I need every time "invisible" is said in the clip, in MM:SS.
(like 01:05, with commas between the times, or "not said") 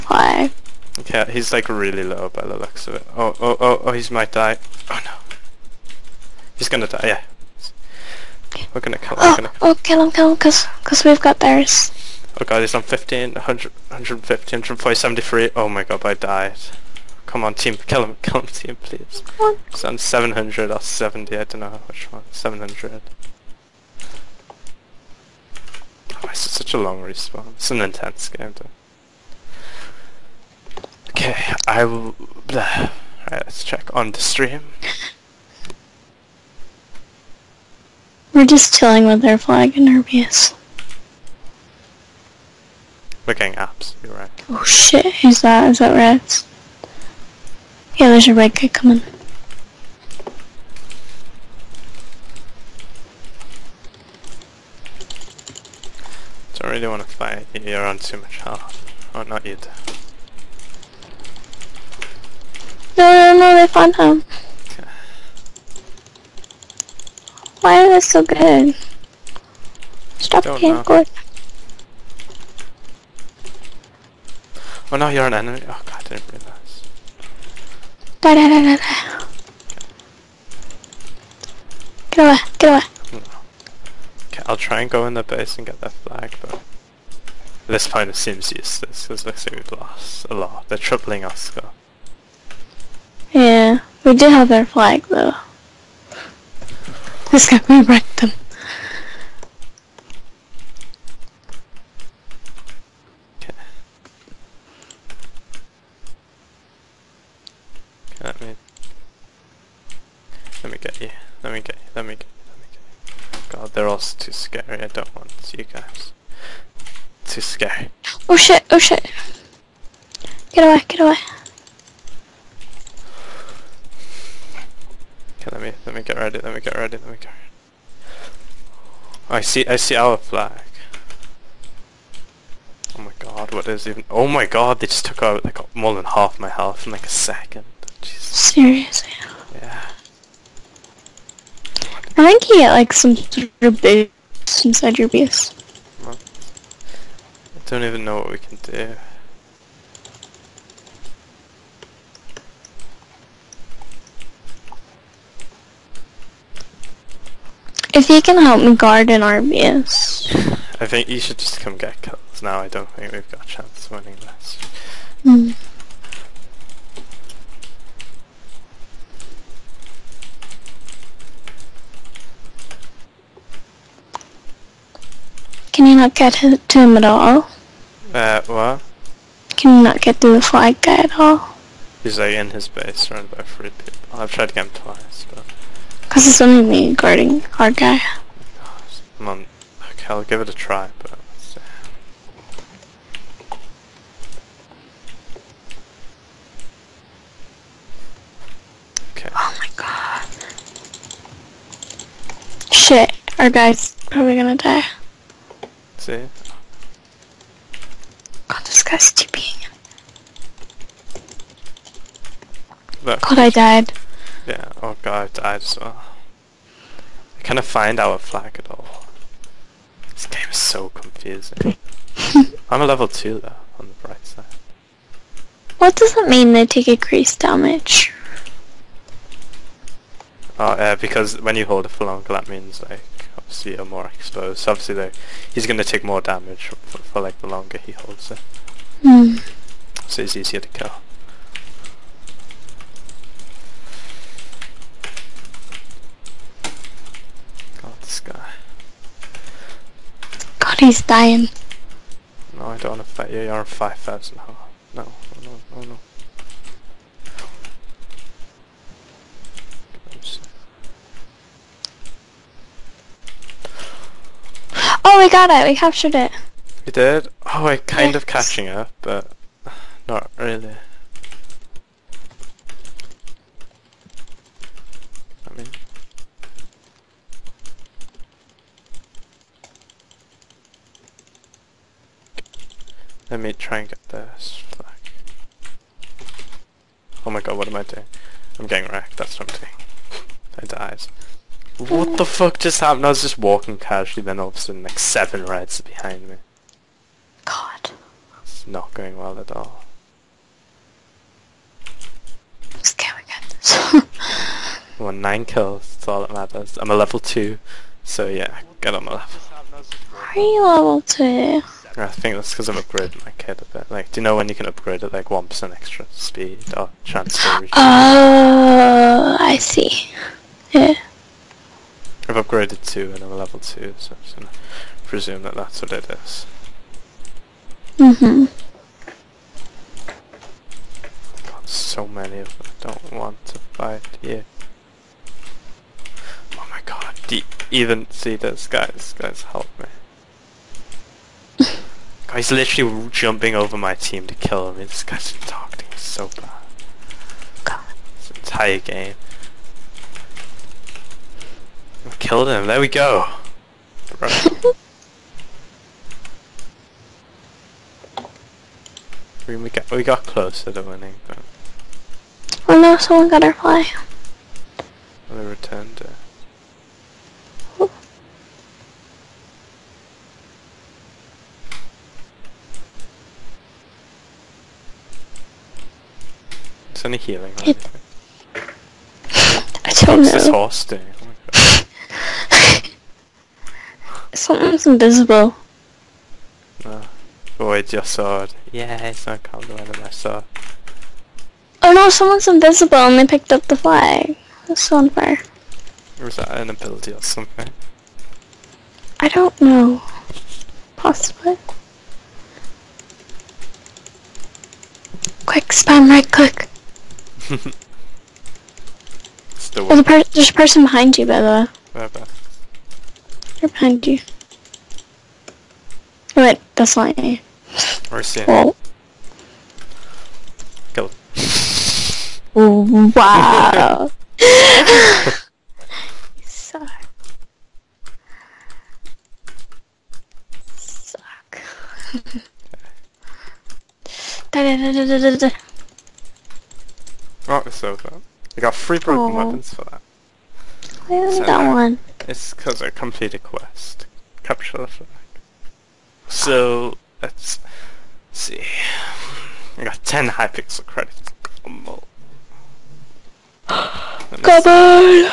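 06:24, 06:32.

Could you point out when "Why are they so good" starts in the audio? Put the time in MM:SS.
01:07.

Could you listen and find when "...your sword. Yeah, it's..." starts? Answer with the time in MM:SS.
06:27.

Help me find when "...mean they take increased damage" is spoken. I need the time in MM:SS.
03:46.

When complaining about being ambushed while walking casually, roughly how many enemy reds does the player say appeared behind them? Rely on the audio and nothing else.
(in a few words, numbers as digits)
7.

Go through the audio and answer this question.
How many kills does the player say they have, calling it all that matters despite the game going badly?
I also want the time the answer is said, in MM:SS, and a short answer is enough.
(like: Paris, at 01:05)
9, at 05:05.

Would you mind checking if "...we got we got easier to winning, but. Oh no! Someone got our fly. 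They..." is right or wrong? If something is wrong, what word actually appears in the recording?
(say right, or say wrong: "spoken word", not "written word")
wrong: "closer", not "easier".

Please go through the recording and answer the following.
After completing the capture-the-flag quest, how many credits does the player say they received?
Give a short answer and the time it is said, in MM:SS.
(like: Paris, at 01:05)
10, at 07:30.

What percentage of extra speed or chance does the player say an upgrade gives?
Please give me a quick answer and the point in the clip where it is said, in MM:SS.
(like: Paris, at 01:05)
1%, at 05:15.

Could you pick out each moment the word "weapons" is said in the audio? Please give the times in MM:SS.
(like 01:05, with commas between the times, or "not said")
07:19.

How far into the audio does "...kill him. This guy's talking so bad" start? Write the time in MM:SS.
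05:44.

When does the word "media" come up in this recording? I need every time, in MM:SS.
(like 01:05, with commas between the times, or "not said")
not said.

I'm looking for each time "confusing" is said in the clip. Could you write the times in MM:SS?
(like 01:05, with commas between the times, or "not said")
03:40.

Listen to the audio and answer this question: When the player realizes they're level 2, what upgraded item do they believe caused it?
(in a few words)
kit.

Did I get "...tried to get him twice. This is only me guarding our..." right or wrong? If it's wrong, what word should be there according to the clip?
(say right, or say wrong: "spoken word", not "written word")
right.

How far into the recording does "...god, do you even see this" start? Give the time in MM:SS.
05:36.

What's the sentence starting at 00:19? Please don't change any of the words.
He's on 700 or 70, I don't know which one.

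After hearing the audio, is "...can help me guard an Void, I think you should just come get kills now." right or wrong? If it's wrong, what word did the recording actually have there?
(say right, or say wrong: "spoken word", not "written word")
wrong: "RBS", not "Void".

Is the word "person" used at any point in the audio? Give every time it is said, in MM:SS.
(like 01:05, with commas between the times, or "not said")
06:50.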